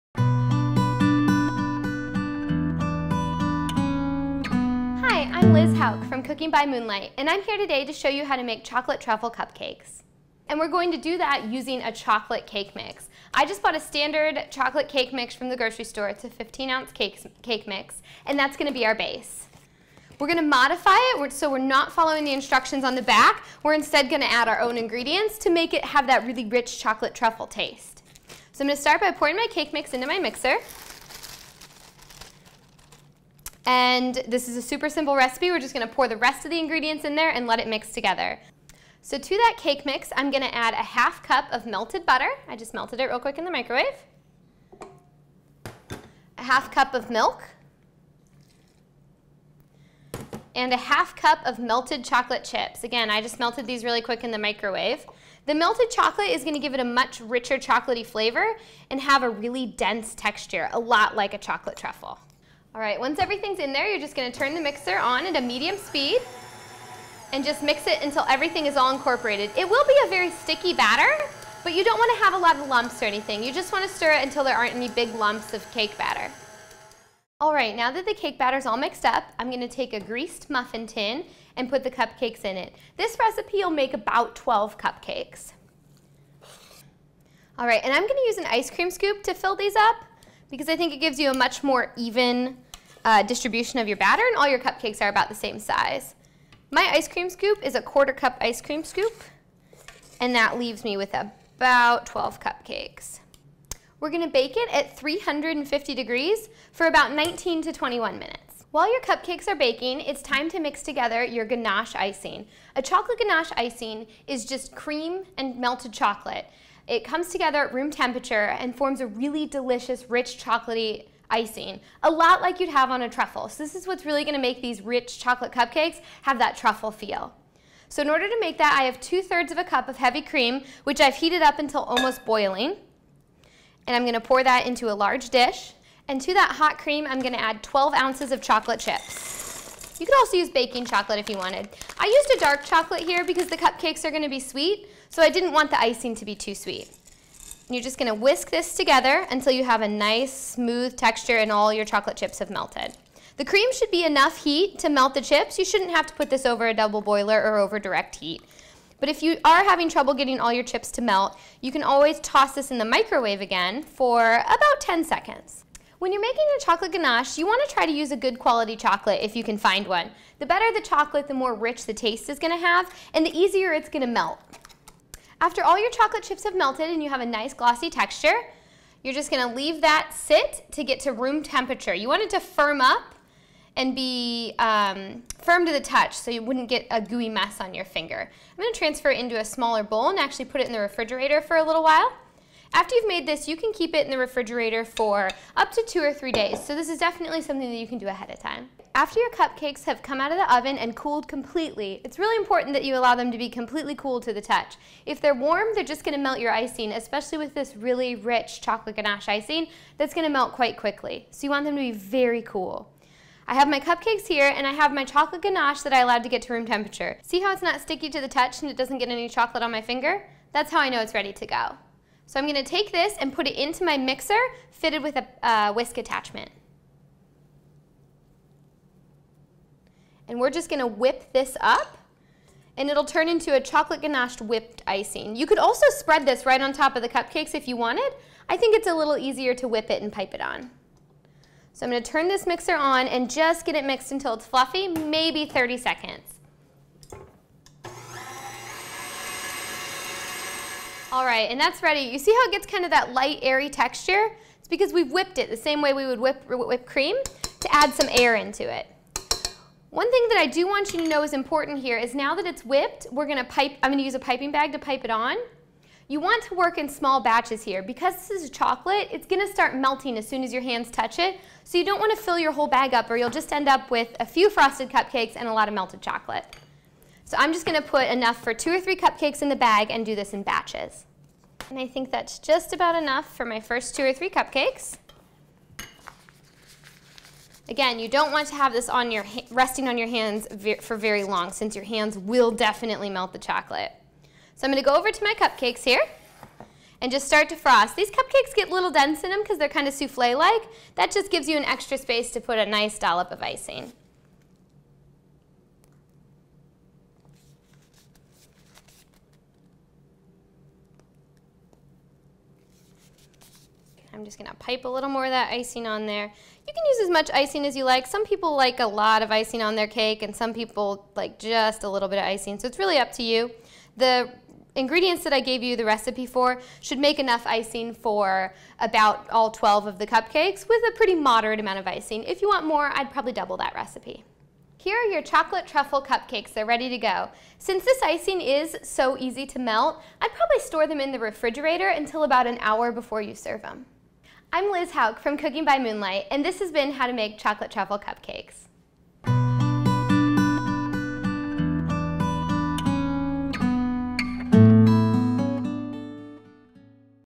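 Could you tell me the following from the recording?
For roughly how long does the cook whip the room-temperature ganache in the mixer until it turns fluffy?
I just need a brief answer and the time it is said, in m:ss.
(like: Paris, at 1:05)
30 seconds, at 4:05.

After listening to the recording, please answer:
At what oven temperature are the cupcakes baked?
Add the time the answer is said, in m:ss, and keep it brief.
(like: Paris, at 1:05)
350 degrees, at 1:44.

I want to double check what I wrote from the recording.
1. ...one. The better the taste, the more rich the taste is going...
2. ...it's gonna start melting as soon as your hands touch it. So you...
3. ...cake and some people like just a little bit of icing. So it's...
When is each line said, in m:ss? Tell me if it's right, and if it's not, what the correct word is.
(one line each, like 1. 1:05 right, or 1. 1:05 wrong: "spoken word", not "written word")
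1. 2:49 wrong: "chocolate", not "taste"
2. 4:29 right
3. 5:19 right.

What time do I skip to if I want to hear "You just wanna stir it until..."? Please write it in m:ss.
1:13.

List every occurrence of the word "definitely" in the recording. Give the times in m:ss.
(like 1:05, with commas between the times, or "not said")
3:16, 4:52.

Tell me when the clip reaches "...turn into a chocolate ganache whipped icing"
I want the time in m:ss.
3:53.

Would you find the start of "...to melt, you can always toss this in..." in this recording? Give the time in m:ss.
2:40.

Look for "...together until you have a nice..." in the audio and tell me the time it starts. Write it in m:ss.
2:28.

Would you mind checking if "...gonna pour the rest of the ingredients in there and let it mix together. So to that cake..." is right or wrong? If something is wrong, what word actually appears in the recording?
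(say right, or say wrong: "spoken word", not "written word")
right.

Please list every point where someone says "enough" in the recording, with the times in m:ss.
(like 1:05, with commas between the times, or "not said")
2:34, 4:38, 4:42, 5:27.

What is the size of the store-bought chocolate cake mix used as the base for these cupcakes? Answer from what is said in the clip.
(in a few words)
15 ounce.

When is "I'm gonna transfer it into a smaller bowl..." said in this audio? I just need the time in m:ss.
3:08.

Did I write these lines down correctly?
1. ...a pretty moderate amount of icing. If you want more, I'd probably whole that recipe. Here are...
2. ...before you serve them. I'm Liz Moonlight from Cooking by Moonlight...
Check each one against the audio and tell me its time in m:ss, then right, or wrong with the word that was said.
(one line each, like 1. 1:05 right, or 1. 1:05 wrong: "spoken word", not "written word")
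1. 5:30 wrong: "double", not "whole"
2. 5:42 wrong: "Houck", not "Moonlight".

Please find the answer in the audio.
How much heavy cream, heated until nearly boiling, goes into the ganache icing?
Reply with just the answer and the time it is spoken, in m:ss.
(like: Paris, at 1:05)
2/3 cup, at 2:08.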